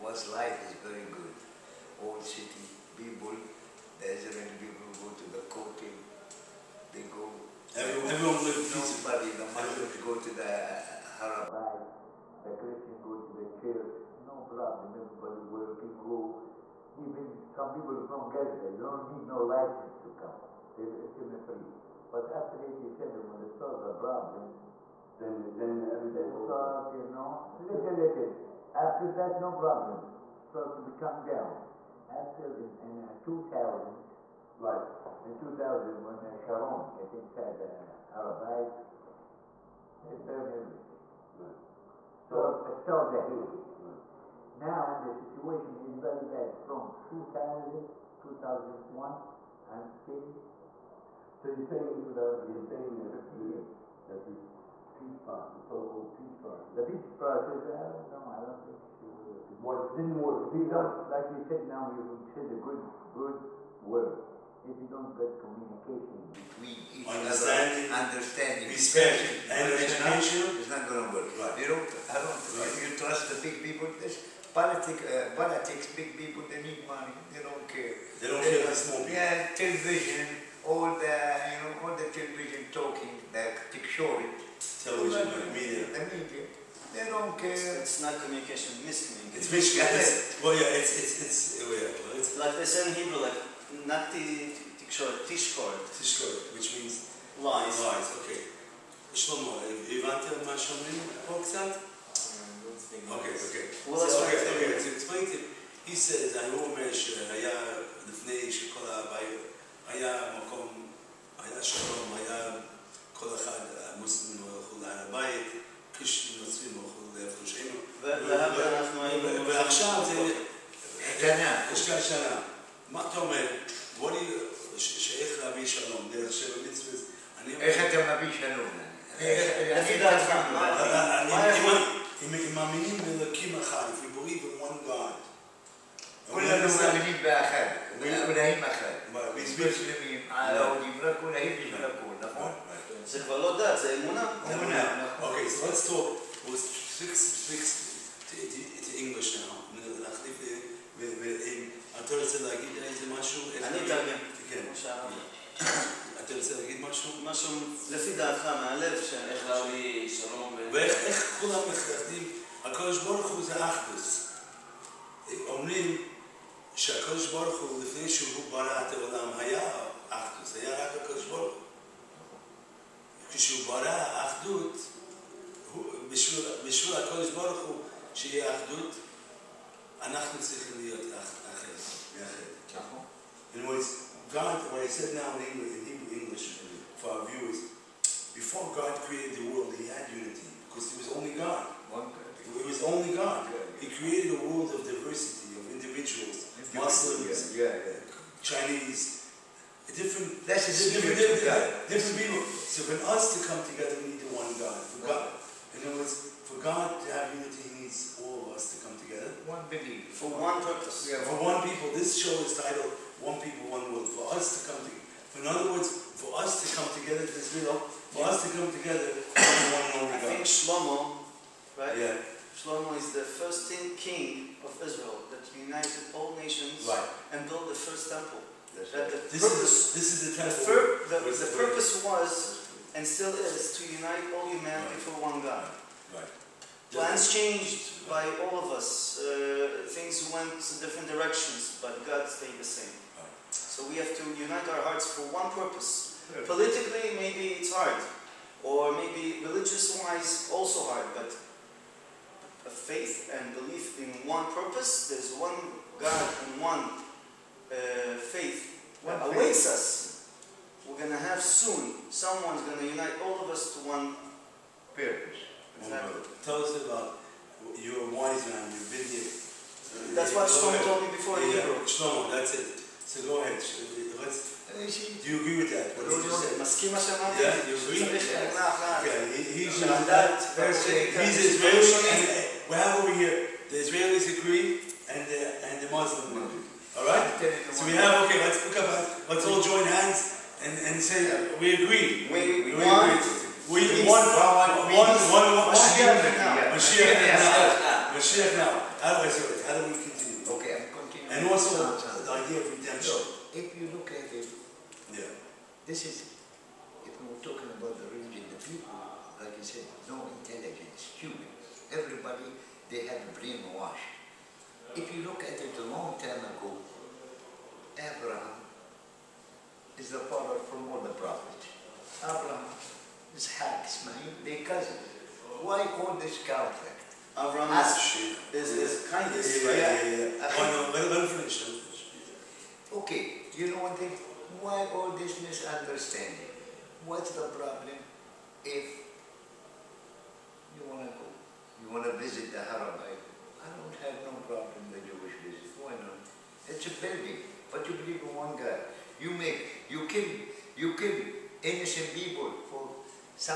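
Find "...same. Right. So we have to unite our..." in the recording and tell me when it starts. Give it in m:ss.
4:02.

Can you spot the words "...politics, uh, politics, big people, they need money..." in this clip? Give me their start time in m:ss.
1:14.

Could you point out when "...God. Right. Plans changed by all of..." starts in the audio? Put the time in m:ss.
3:55.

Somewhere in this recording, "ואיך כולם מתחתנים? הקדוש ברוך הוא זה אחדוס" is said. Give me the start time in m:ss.
2:40.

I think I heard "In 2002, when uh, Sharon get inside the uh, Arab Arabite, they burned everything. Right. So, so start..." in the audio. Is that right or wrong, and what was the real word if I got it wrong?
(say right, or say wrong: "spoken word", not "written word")
wrong: "2000", not "2002".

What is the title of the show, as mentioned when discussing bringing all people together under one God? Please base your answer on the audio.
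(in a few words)
One People, One World.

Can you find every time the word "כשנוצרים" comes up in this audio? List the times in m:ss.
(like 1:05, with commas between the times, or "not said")
1:55.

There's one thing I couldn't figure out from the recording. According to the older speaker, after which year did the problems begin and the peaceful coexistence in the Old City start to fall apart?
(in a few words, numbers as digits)
1987.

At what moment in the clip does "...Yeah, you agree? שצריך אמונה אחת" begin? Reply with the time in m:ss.
4:37.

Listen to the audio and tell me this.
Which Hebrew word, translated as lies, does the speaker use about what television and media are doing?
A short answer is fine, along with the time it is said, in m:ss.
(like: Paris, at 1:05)
Tikshori, at 1:23.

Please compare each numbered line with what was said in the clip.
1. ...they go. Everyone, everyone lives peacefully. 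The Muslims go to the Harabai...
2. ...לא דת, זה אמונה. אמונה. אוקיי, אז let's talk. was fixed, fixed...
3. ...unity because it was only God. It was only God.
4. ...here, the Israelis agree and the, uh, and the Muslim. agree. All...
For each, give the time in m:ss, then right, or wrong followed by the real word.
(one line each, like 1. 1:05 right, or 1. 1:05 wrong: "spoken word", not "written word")
1. 0:06 right
2. 2:23 right
3. 3:10 right
4. 4:43 right.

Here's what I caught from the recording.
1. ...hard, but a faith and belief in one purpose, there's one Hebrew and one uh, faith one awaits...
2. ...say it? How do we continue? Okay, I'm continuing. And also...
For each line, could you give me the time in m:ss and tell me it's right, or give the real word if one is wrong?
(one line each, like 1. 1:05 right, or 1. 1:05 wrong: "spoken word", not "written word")
1. 4:10 wrong: "God", not "Hebrew"
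2. 4:59 right.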